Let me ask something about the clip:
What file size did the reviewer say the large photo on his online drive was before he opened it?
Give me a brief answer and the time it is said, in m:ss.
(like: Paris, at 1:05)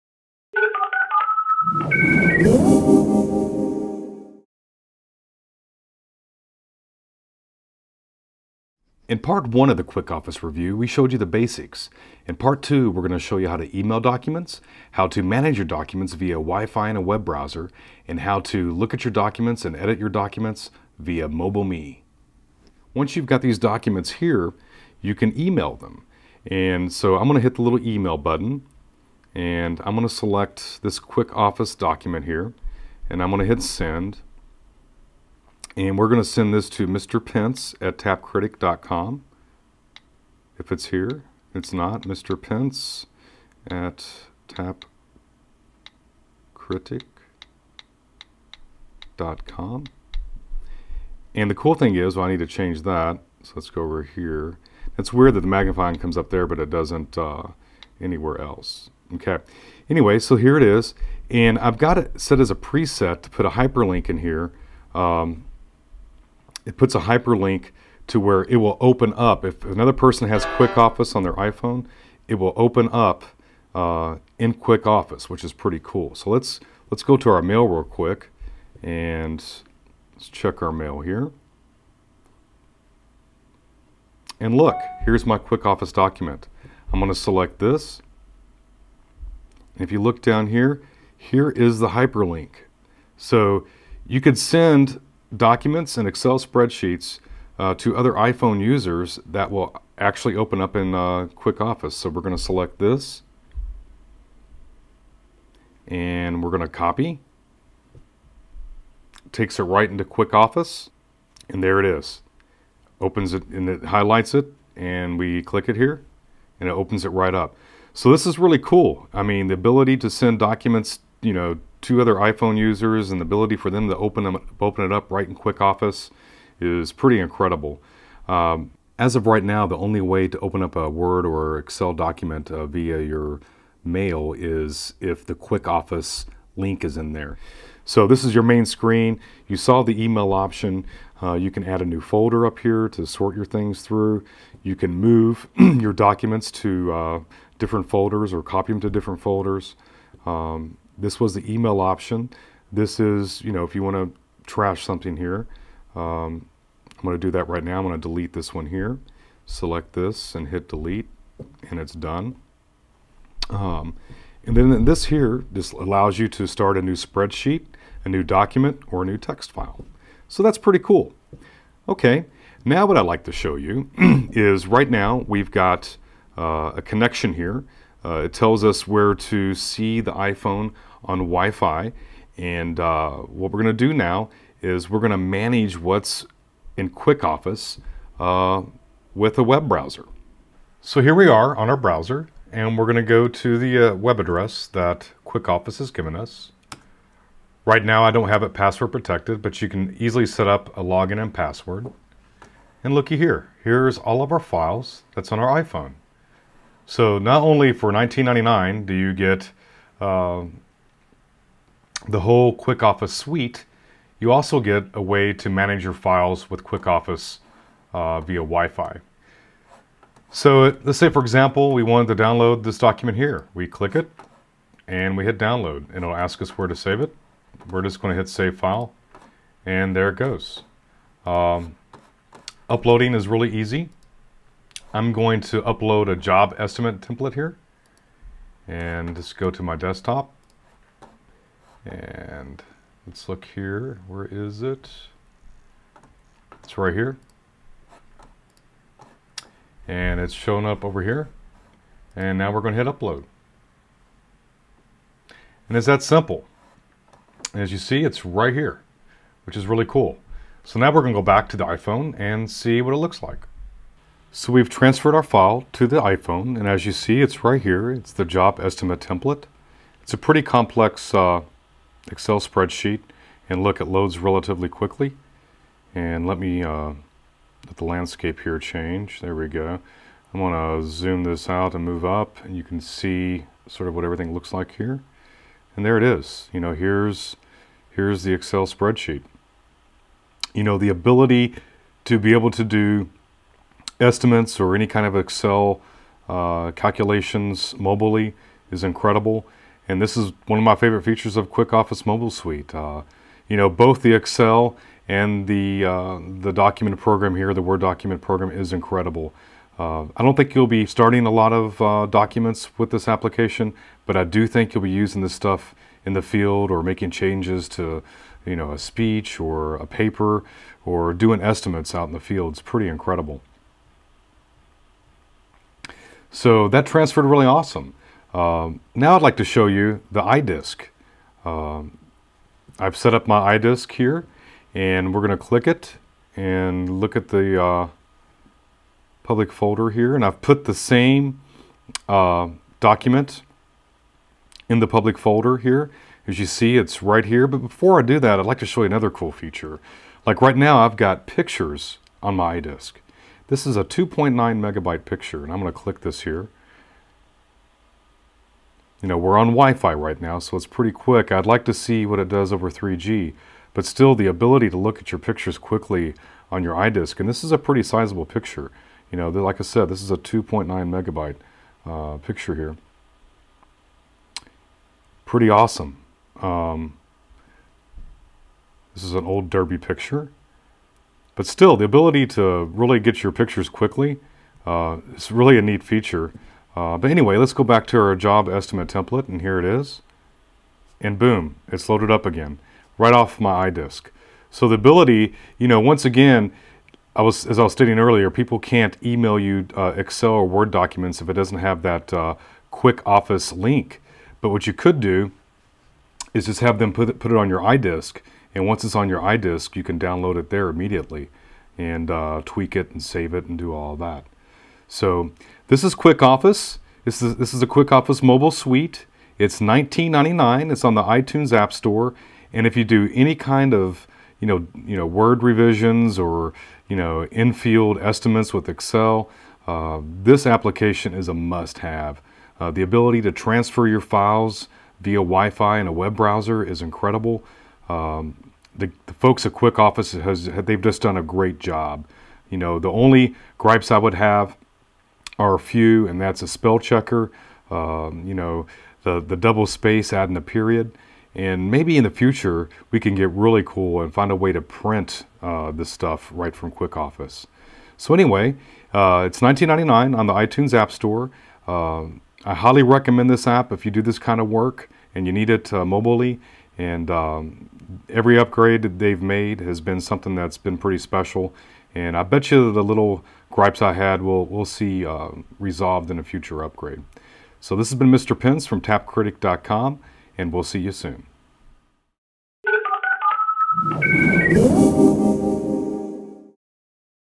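2.9 megabytes, at 5:53.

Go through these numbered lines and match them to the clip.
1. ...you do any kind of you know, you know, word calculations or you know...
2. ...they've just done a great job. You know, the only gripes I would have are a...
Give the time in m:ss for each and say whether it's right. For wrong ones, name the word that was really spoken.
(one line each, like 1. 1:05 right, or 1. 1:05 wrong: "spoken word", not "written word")
1. 7:02 wrong: "revisions", not "calculations"
2. 7:20 right.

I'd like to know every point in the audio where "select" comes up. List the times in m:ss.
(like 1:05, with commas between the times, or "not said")
0:30, 1:27, 1:42, 2:39.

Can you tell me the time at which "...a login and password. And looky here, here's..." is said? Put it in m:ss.
3:20.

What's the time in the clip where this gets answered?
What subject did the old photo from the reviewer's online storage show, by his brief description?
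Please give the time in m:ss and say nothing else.
6:19.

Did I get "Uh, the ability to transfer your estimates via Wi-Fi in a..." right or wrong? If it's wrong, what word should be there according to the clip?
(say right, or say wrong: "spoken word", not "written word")
wrong: "files", not "estimates".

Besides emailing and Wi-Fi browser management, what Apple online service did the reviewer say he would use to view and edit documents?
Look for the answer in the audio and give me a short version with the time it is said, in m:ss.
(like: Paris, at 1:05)
MobileMe, at 0:21.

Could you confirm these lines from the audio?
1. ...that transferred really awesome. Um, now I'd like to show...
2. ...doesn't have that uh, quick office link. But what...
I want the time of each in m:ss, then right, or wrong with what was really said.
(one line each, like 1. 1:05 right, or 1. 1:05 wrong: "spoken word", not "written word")
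1. 5:26 right
2. 6:41 right.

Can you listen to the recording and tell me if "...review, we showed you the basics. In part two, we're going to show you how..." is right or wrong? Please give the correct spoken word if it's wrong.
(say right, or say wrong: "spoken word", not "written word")
right.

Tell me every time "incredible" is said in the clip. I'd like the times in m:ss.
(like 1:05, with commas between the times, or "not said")
2:07, 4:58, 5:08, 5:22, 7:16.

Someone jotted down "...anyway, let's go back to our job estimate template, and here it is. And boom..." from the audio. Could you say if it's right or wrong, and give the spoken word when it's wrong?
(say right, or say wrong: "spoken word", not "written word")
right.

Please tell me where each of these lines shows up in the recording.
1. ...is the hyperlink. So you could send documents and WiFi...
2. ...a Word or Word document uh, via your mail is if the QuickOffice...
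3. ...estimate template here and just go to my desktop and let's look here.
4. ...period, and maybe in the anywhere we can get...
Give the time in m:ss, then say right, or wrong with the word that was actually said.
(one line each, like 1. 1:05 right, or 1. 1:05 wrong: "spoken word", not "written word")
1. 1:31 wrong: "Excel", not "WiFi"
2. 2:10 wrong: "Excel", not "Word"
3. 3:56 right
4. 7:30 wrong: "future", not "anywhere".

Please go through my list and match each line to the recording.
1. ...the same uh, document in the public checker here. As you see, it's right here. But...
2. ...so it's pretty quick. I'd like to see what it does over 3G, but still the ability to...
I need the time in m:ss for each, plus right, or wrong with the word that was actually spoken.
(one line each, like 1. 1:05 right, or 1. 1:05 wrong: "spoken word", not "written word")
1. 5:40 wrong: "folder", not "checker"
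2. 6:00 right.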